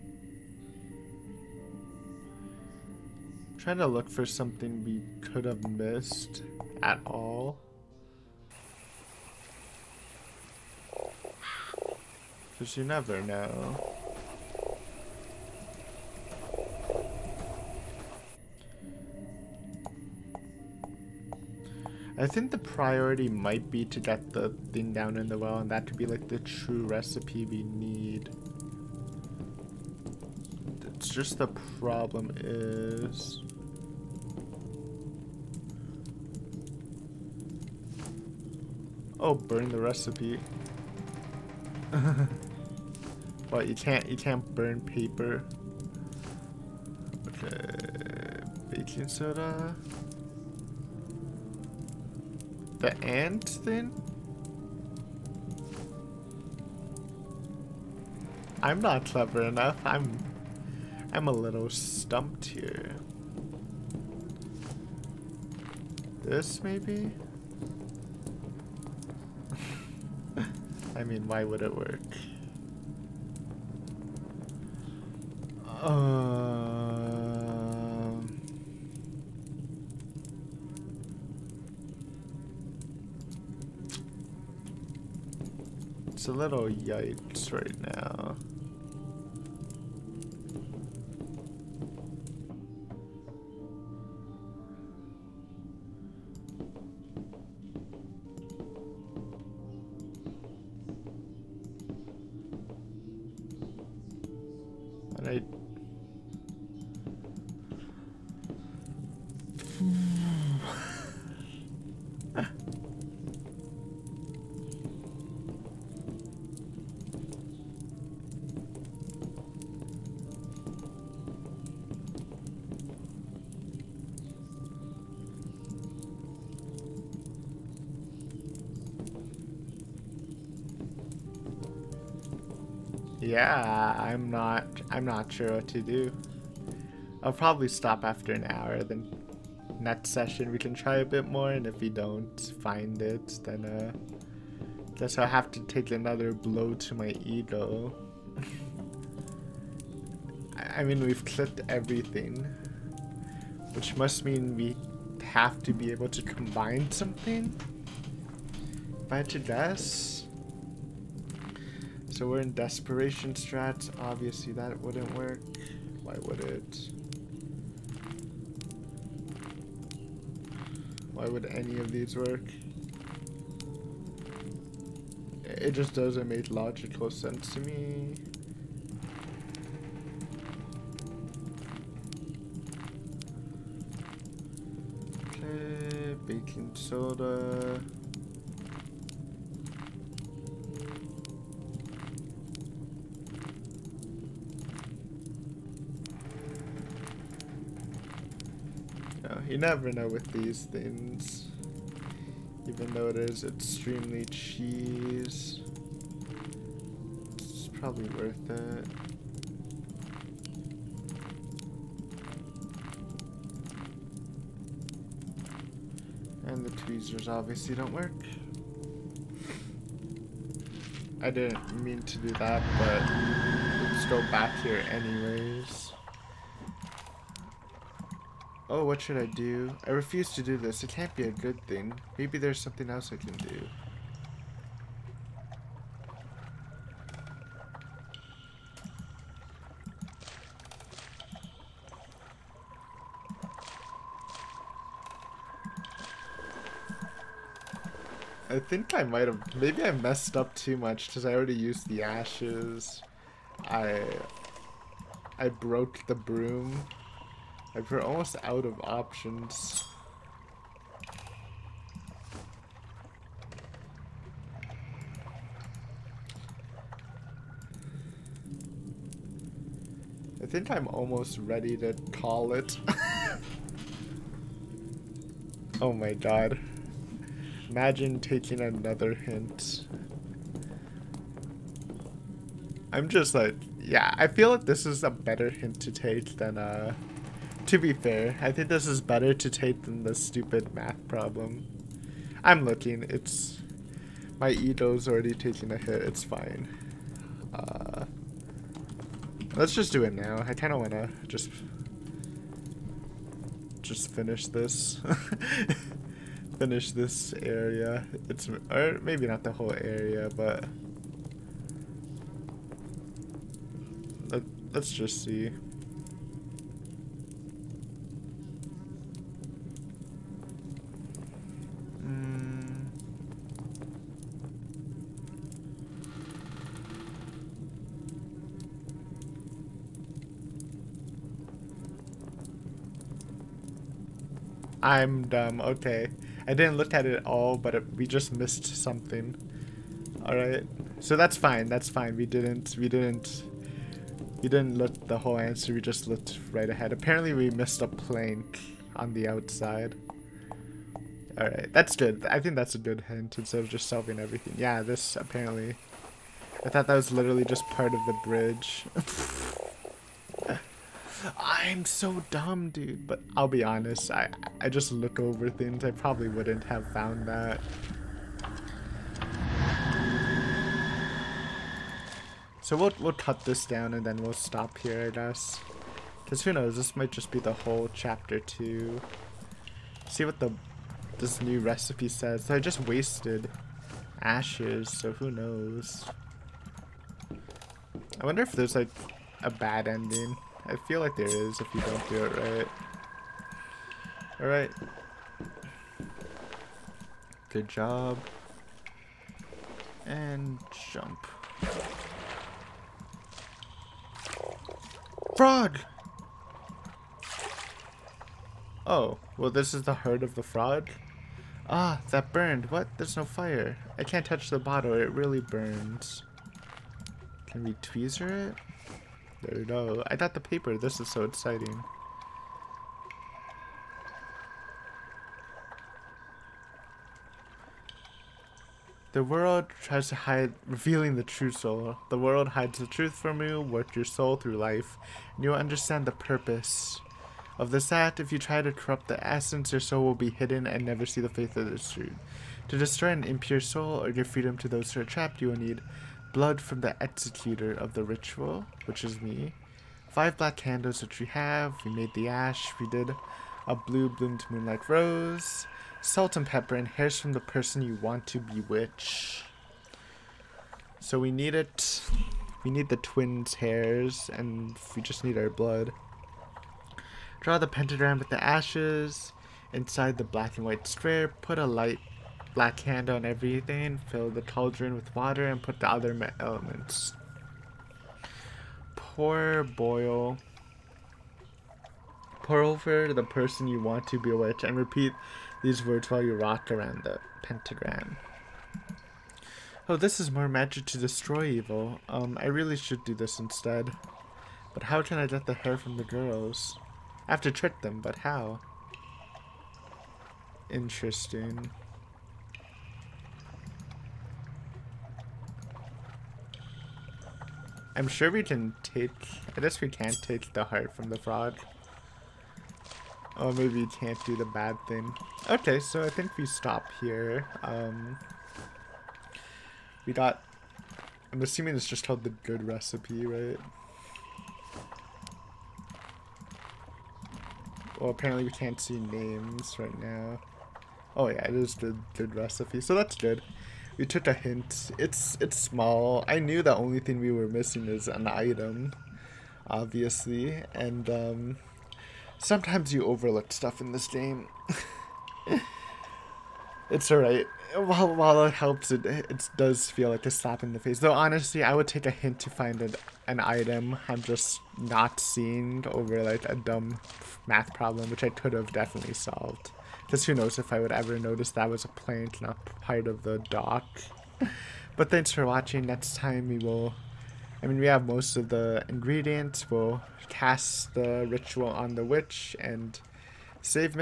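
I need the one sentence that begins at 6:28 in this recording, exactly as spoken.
I wonder if there's like a bad ending.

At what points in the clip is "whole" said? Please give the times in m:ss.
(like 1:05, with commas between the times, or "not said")
5:09, 5:45, 6:17.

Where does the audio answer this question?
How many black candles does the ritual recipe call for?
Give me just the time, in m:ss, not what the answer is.
7:30.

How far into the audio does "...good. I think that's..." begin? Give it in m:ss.
5:51.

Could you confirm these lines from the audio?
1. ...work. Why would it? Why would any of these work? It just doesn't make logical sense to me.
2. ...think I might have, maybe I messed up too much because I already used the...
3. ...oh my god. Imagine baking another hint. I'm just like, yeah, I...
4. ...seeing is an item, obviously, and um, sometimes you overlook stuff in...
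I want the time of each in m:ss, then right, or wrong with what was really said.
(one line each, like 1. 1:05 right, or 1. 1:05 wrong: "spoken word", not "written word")
1. 2:45 right
2. 4:08 right
3. 4:35 wrong: "taking", not "baking"
4. 8:57 wrong: "missing", not "seeing".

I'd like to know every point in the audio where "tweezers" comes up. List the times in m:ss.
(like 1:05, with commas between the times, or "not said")
3:36, 6:57.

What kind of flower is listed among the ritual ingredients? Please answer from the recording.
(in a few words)
blue bloomed moonlight rose.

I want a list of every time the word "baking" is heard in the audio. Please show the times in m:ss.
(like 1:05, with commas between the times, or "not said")
0:48, 3:06.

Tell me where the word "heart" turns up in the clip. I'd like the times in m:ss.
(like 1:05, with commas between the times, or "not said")
6:49, 8:30.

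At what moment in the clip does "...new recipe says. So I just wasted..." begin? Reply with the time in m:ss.
6:21.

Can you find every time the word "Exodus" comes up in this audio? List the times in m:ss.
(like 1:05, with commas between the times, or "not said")
not said.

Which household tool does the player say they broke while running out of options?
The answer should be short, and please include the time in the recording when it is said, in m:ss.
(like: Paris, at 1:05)
the broom, at 4:15.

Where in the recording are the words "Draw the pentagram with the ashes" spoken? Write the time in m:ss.
7:47.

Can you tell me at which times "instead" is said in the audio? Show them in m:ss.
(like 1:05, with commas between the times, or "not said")
5:53, 8:13.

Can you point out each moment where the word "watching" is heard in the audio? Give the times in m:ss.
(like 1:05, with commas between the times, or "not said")
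9:25.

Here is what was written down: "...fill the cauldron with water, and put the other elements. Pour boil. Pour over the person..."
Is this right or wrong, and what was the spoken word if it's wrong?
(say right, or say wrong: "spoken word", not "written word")
right.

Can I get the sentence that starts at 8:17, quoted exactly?
I have to trick them, but how?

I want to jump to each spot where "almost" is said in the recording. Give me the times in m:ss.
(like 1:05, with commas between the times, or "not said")
4:18, 4:30.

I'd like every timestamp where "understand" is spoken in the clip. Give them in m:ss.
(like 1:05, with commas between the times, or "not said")
7:15.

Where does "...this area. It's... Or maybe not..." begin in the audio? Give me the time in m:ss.
5:06.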